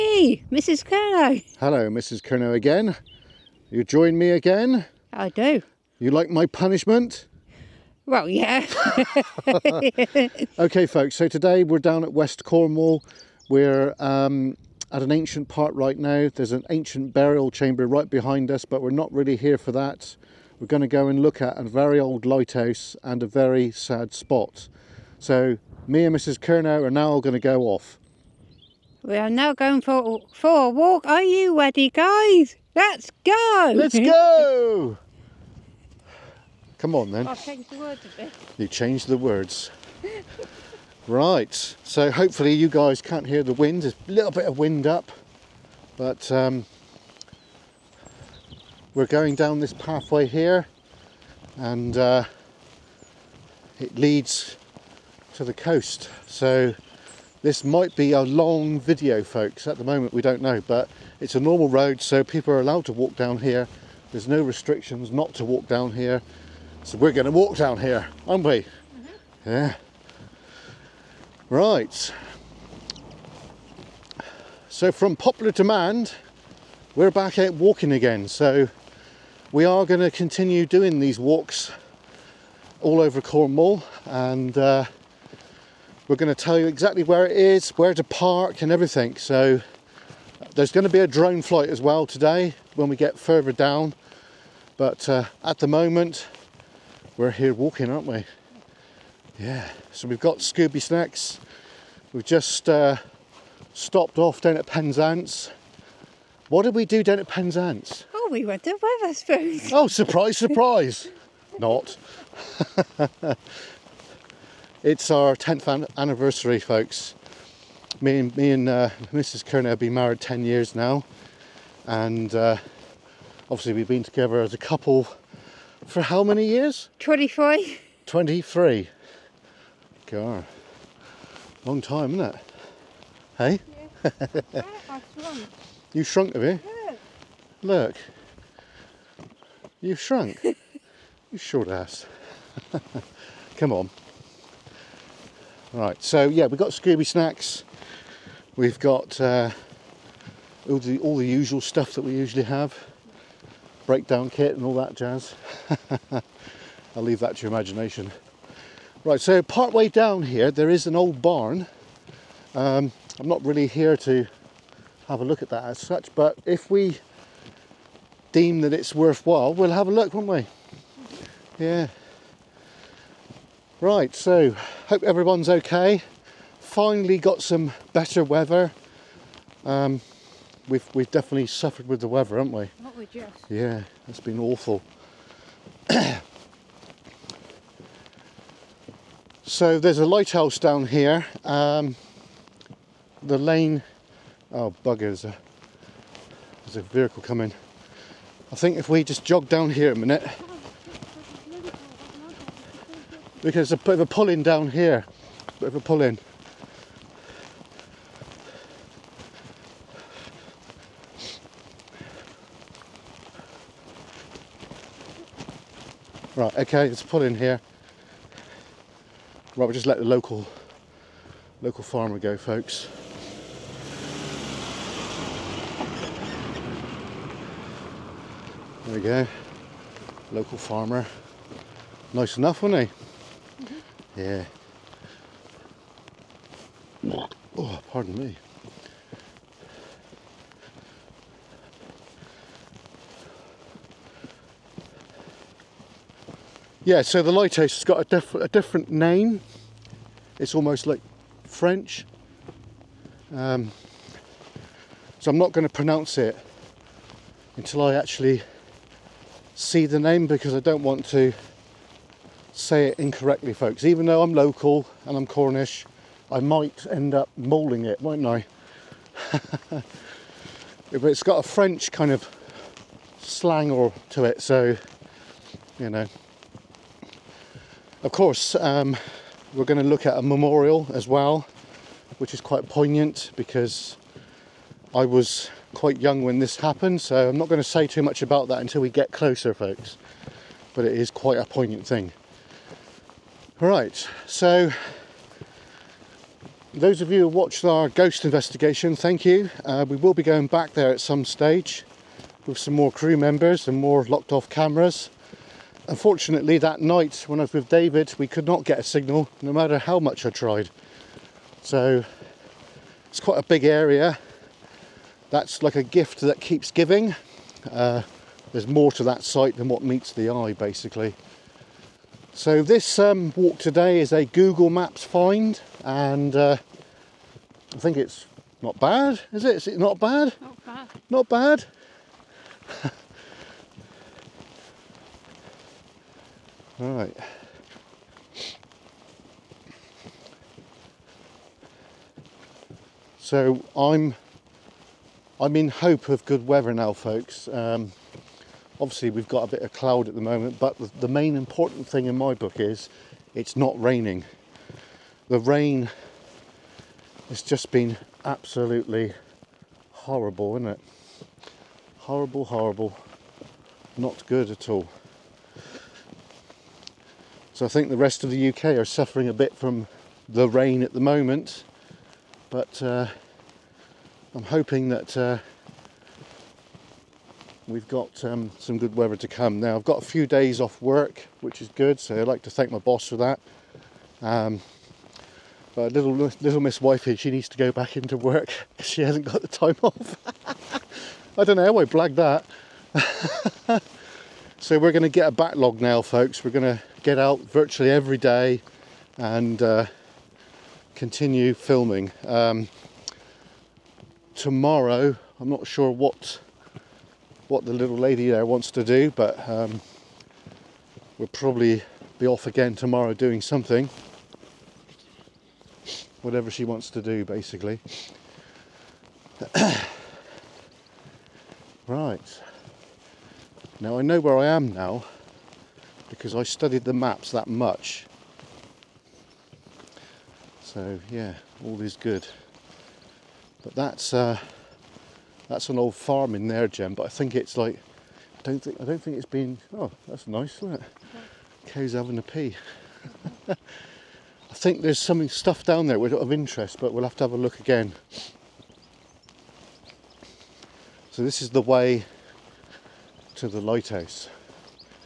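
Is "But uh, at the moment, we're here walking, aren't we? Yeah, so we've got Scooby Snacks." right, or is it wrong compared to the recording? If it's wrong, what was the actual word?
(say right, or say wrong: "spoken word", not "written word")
right.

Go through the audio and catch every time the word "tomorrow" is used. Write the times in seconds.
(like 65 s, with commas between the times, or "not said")
404 s, 412 s.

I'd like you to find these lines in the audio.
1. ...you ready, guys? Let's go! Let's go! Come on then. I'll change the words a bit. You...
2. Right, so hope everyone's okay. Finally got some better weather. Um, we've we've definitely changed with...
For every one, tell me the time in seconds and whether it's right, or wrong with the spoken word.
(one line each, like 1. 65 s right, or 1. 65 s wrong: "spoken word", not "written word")
1. 31 s right
2. 173 s wrong: "suffered", not "changed".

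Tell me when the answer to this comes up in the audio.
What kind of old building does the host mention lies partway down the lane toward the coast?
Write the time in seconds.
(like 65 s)
161 s.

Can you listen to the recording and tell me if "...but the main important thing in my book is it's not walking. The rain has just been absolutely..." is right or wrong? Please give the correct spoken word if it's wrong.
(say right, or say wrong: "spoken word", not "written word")
wrong: "raining", not "walking".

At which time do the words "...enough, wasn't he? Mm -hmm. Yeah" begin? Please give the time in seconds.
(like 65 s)
232 s.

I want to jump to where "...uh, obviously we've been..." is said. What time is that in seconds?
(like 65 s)
122 s.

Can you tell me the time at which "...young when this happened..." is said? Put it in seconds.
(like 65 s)
285 s.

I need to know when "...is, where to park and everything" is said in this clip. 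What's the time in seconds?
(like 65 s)
87 s.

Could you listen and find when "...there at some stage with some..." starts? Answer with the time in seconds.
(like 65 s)
300 s.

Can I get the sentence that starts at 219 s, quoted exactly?
Right, we'll just let the local local farmer go, folks.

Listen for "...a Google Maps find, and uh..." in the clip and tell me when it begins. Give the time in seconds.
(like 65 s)
324 s.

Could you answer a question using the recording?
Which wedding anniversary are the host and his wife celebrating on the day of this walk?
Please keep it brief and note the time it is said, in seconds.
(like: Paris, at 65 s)
10th, at 115 s.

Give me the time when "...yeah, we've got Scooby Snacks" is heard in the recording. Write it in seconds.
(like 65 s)
146 s.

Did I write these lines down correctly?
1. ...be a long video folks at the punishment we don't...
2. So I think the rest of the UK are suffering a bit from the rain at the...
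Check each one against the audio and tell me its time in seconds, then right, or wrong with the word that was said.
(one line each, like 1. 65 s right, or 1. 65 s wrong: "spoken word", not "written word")
1. 57 s wrong: "moment", not "punishment"
2. 367 s right.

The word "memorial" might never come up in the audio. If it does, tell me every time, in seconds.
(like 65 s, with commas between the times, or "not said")
280 s.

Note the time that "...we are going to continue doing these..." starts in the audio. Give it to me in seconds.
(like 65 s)
79 s.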